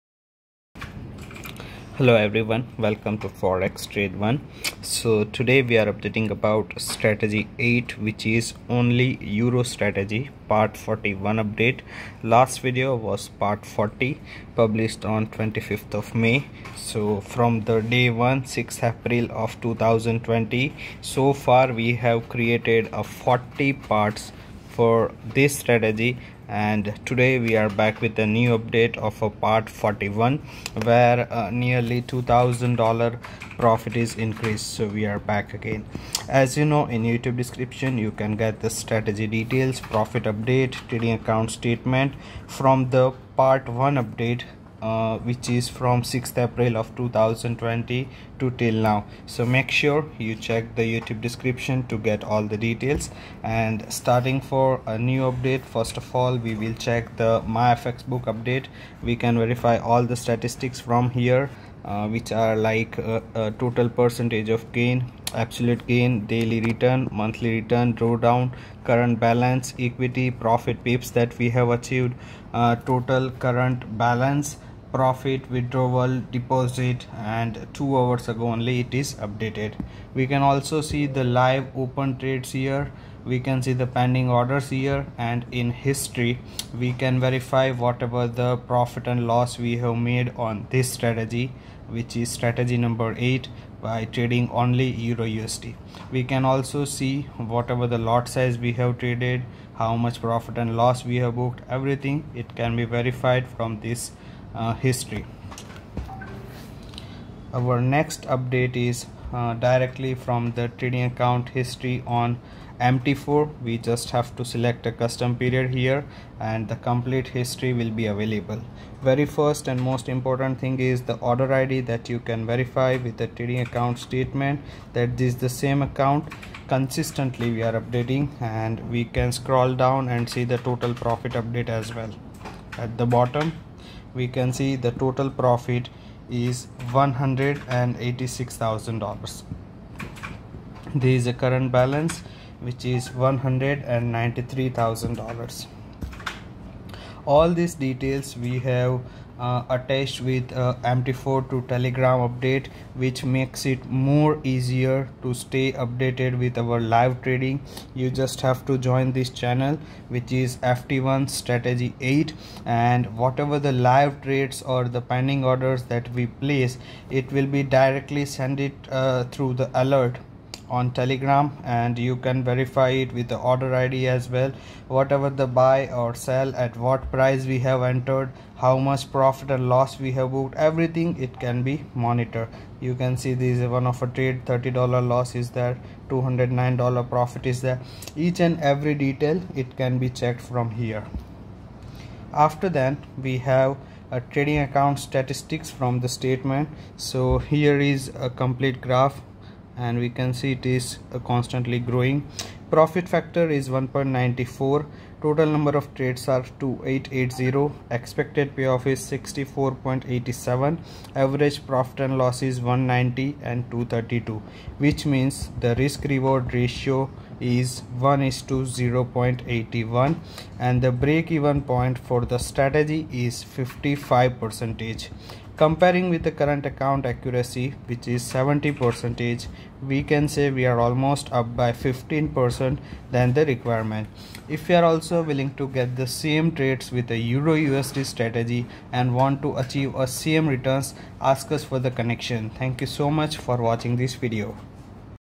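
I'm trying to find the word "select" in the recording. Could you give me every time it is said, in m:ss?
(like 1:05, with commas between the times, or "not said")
1:54.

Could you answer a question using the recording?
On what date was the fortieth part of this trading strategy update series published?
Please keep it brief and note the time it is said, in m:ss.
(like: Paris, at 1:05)
25th of May, at 0:15.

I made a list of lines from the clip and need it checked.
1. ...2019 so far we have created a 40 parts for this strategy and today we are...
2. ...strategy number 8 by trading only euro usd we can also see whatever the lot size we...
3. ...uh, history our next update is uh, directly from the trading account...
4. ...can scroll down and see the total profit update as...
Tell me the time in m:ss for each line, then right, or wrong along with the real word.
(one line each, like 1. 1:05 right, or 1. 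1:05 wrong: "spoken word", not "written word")
1. 0:19 wrong: "2020", not "2019"
2. 1:32 right
3. 1:44 right
4. 2:09 right.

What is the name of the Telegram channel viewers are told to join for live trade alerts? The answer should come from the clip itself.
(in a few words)
FT1 Strategy 8.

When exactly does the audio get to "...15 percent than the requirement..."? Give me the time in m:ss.
3:51.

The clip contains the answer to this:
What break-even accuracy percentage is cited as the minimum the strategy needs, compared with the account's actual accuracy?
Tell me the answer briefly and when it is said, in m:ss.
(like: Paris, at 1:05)
55%, at 3:43.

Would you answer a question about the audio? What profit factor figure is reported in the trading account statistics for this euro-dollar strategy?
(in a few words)
1.94.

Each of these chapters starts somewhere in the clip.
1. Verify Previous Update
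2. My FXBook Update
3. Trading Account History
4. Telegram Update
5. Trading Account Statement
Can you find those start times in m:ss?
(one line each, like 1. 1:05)
1. 0:10
2. 0:55
3. 1:45
4. 2:25
5. 3:15.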